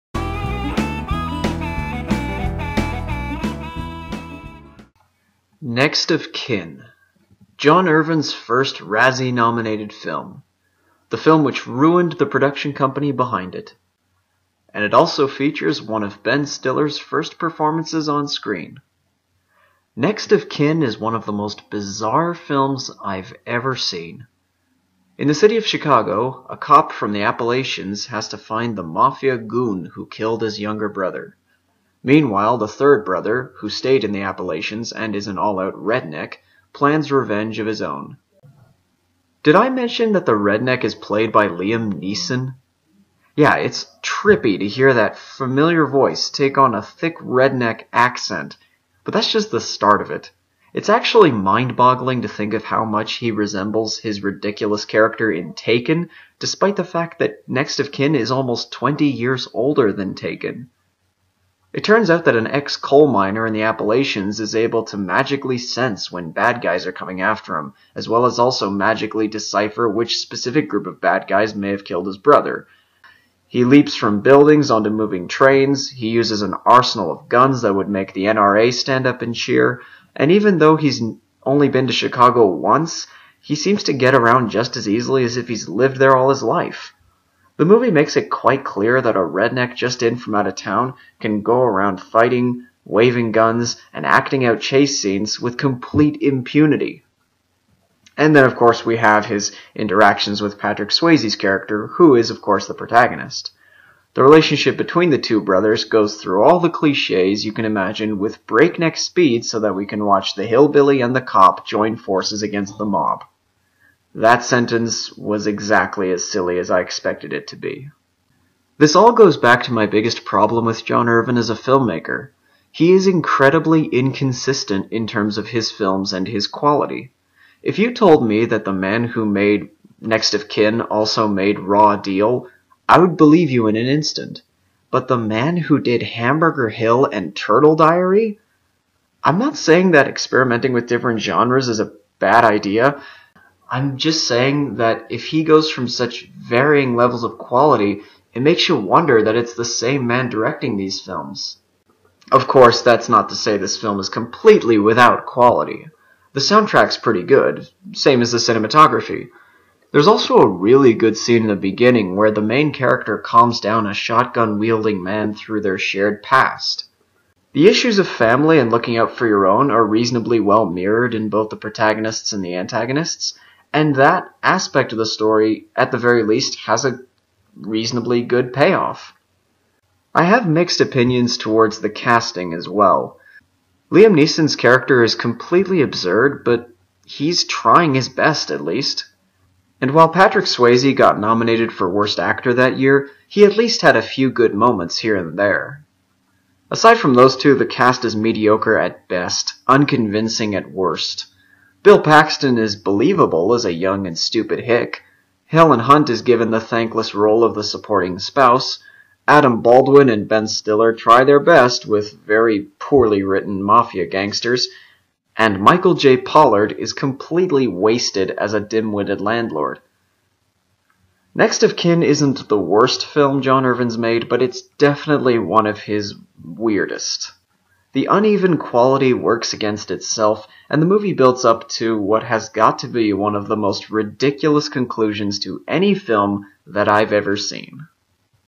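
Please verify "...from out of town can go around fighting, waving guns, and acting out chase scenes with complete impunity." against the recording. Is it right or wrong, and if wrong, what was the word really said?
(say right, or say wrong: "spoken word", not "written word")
right.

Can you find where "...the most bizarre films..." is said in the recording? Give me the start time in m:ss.
0:21.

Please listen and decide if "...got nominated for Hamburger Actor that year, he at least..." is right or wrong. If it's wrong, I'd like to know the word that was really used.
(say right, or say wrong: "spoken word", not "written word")
wrong: "Worst", not "Hamburger".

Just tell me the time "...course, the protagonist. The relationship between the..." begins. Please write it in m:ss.
1:42.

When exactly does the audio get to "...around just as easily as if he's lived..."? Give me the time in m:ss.
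1:24.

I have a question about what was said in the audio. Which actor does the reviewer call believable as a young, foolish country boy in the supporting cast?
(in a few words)
Bill Paxton.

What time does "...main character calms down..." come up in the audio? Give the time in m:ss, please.
2:42.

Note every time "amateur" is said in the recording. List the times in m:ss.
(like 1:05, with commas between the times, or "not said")
not said.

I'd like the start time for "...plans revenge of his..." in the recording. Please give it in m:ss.
0:36.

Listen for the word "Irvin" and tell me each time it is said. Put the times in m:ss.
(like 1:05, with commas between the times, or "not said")
0:07, 2:01, 3:43.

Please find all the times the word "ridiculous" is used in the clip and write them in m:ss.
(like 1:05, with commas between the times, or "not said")
0:54, 3:53.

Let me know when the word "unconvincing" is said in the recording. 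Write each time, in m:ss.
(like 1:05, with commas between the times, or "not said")
3:19.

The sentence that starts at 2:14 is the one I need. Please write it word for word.
But the man who did Hamburger Hill and Turtle Diary?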